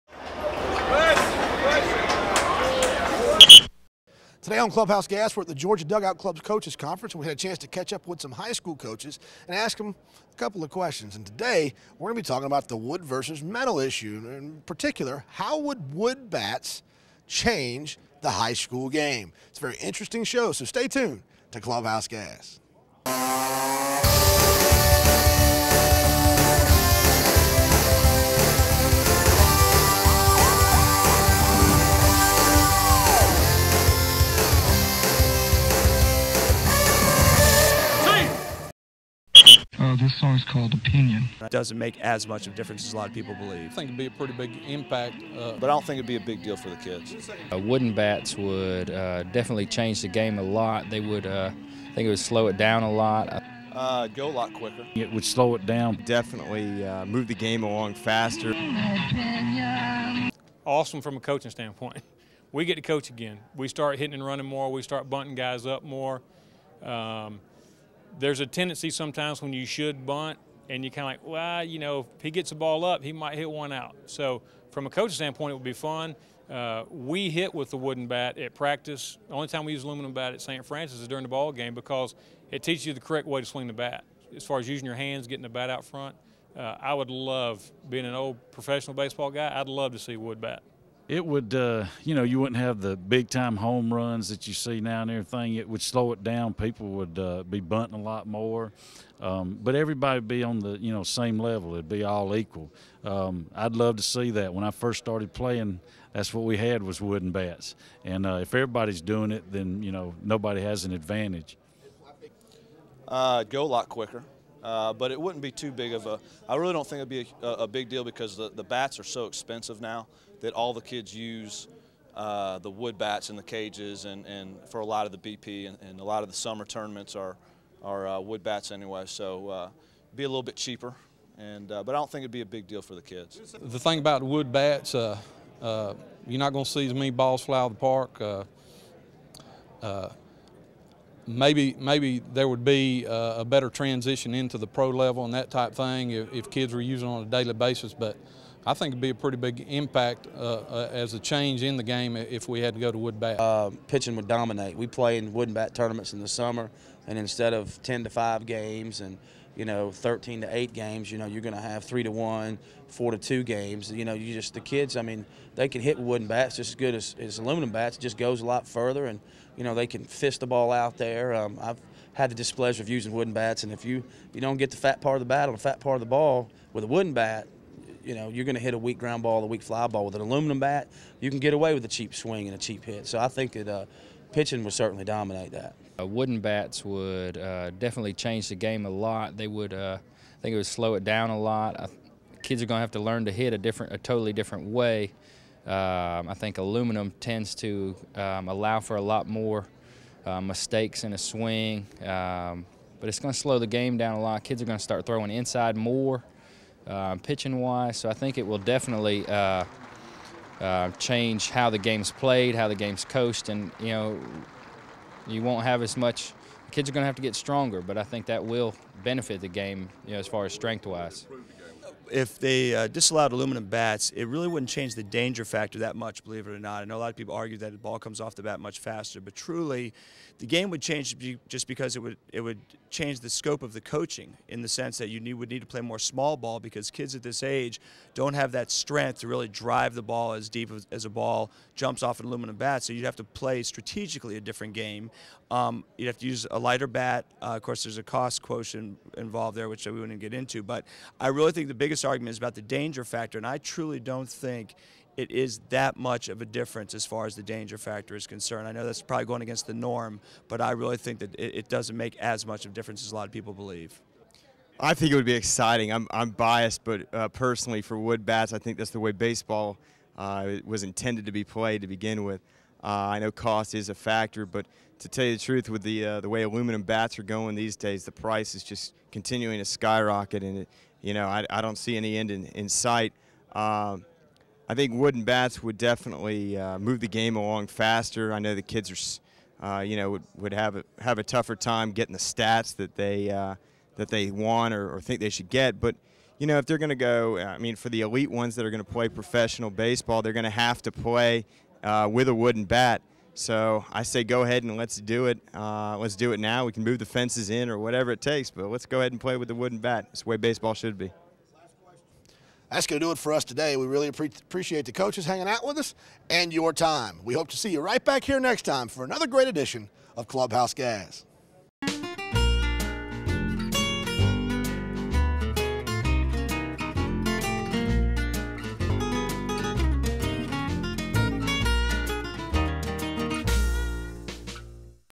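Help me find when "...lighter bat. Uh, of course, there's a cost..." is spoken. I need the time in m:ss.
4:06.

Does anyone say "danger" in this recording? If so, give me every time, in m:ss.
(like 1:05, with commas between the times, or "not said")
3:45, 4:12, 4:17.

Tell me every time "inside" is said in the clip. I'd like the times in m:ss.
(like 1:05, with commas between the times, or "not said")
3:25.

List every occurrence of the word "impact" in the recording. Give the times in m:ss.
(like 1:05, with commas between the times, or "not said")
0:44, 2:29.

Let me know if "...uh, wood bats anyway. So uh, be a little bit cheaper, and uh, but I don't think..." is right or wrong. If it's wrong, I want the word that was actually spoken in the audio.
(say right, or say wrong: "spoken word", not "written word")
right.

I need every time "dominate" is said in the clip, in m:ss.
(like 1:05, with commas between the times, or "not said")
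2:34, 3:05.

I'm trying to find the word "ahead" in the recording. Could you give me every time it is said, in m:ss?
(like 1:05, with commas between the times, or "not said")
5:04, 5:08.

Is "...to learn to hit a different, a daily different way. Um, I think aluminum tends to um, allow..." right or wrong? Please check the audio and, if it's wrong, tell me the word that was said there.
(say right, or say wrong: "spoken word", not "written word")
wrong: "totally", not "daily".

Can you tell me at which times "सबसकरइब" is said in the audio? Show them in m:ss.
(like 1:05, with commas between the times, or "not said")
not said.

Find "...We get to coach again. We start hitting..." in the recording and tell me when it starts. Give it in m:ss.
1:02.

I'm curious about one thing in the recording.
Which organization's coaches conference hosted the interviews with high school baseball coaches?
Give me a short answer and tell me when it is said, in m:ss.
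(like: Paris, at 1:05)
Georgia Dugout Club, at 0:05.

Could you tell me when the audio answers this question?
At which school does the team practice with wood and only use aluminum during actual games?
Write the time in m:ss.
1:20.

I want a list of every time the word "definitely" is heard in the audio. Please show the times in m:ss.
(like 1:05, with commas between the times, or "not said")
0:49, 0:56, 3:07, 3:28, 4:45.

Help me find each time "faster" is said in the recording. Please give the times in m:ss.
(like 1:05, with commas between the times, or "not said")
0:57, 3:48, 4:47.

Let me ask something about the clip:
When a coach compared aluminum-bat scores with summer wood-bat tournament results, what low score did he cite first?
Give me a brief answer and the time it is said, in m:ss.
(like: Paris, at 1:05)
3 to 1, at 2:41.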